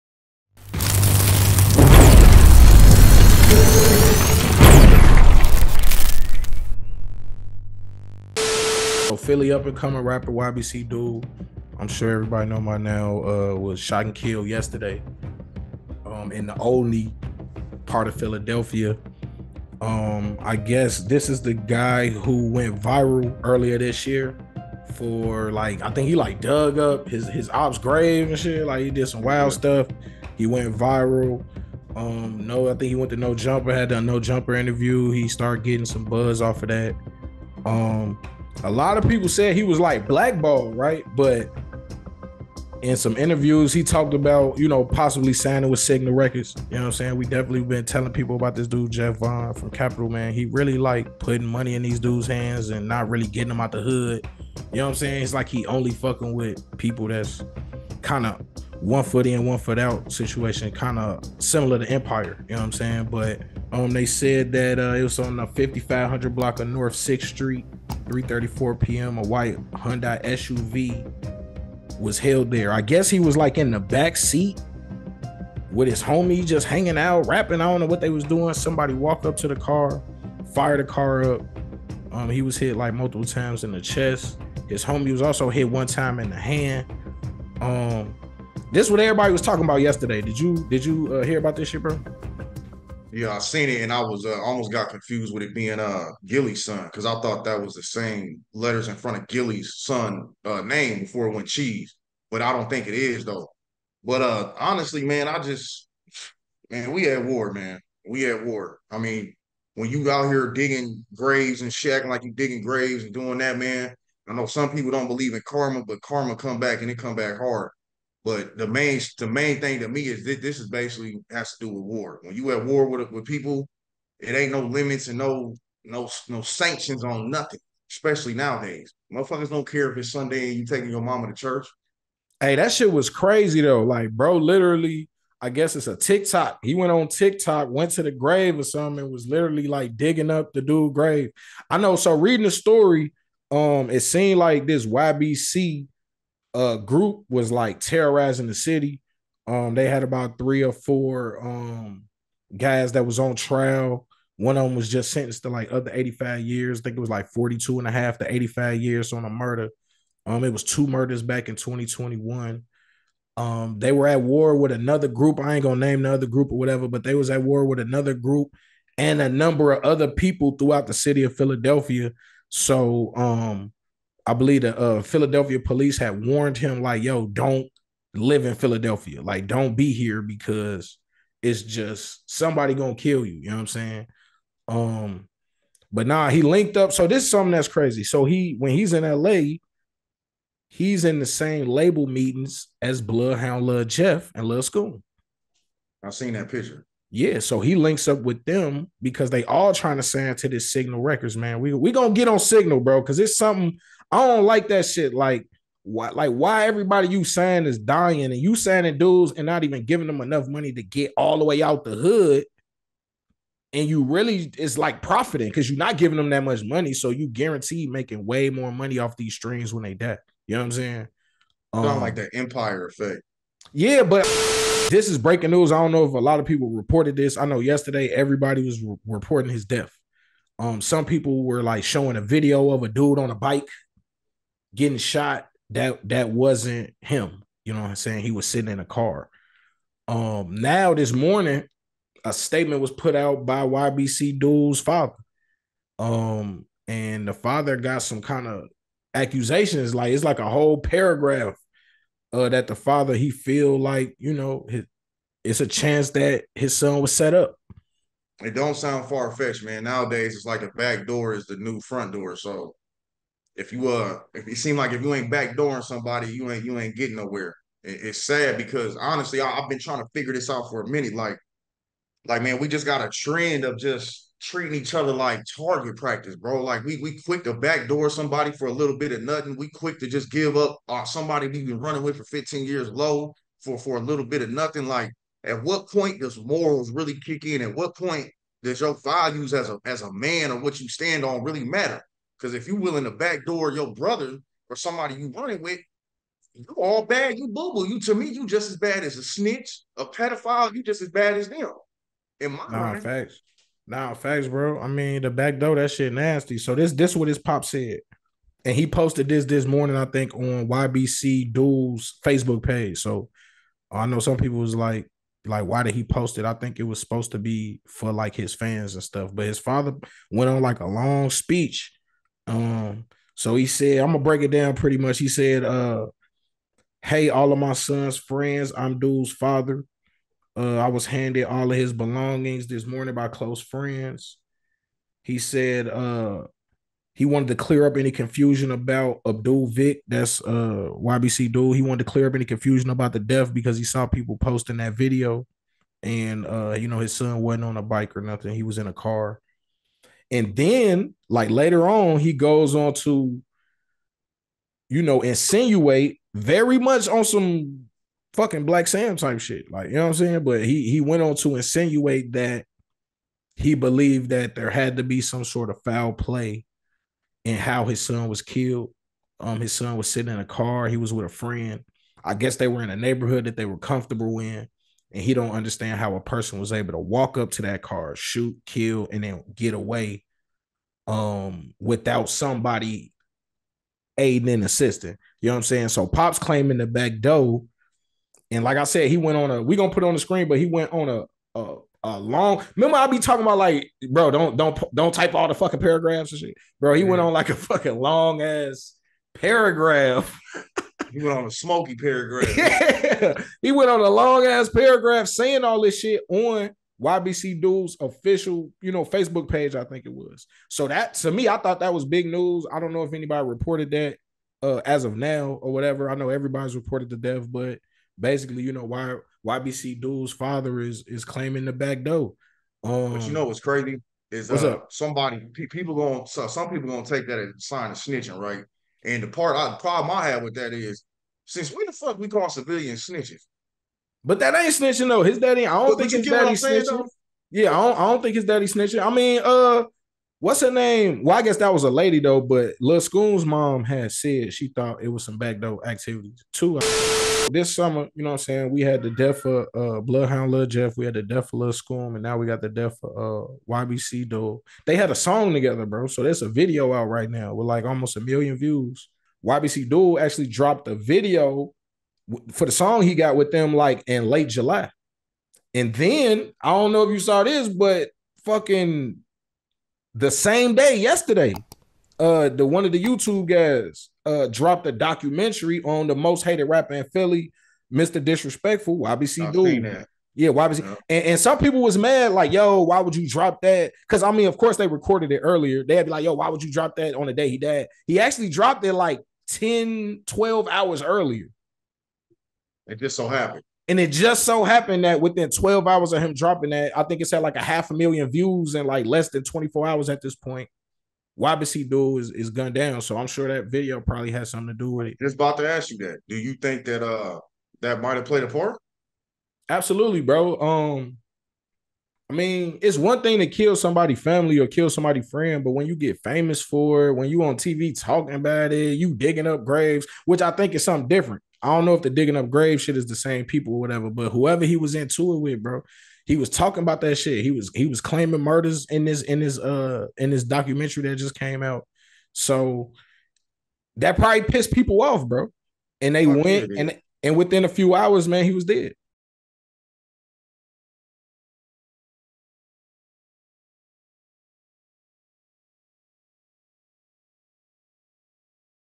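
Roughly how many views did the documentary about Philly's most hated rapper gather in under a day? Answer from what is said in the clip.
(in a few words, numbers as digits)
half a million.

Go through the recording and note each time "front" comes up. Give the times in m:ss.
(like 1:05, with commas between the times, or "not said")
1:38, 4:21.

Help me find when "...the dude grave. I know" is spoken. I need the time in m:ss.
2:20.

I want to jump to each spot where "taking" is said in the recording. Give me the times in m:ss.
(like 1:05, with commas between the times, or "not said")
2:10.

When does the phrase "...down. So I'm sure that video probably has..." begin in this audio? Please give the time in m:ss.
8:22.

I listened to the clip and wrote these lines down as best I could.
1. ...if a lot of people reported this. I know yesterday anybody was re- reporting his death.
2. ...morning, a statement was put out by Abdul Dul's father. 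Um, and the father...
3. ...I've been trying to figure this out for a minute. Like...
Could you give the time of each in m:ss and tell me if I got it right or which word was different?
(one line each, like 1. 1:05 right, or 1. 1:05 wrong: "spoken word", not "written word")
1. 3:46 wrong: "everybody", not "anybody"
2. 4:01 wrong: "YBC", not "Abdul"
3. 4:29 right.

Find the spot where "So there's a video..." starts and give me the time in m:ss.
7:36.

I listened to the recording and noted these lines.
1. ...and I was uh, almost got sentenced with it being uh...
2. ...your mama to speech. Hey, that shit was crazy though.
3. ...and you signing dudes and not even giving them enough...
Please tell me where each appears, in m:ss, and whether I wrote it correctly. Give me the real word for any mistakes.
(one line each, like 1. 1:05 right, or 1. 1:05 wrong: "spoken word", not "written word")
1. 1:33 wrong: "confused", not "sentenced"
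2. 2:10 wrong: "church", not "speech"
3. 3:28 right.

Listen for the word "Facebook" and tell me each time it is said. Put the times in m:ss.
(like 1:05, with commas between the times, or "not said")
5:12, 6:49.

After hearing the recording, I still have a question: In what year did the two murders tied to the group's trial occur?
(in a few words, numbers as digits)
2021.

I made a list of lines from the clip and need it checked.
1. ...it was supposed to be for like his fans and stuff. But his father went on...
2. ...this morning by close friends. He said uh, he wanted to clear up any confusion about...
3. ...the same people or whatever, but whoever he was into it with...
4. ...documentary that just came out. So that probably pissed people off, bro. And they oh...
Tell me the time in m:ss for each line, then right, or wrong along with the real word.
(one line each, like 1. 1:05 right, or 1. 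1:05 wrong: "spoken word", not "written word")
1. 5:16 right
2. 5:32 right
3. 8:43 right
4. 8:50 right.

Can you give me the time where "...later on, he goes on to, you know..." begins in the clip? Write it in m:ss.
5:51.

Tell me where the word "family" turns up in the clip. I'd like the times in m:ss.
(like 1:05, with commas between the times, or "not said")
8:34.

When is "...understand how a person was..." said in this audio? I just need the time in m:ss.
6:15.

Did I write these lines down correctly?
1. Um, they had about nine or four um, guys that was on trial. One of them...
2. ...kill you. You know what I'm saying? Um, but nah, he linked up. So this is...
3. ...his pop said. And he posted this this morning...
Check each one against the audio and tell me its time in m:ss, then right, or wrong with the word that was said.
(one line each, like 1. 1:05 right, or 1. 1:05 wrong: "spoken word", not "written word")
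1. 2:29 wrong: "three", not "nine"
2. 3:02 right
3. 5:07 right.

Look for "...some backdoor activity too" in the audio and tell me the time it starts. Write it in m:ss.
7:25.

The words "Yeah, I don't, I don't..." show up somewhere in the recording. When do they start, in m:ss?
7:17.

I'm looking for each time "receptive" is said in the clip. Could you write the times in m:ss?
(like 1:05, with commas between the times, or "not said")
not said.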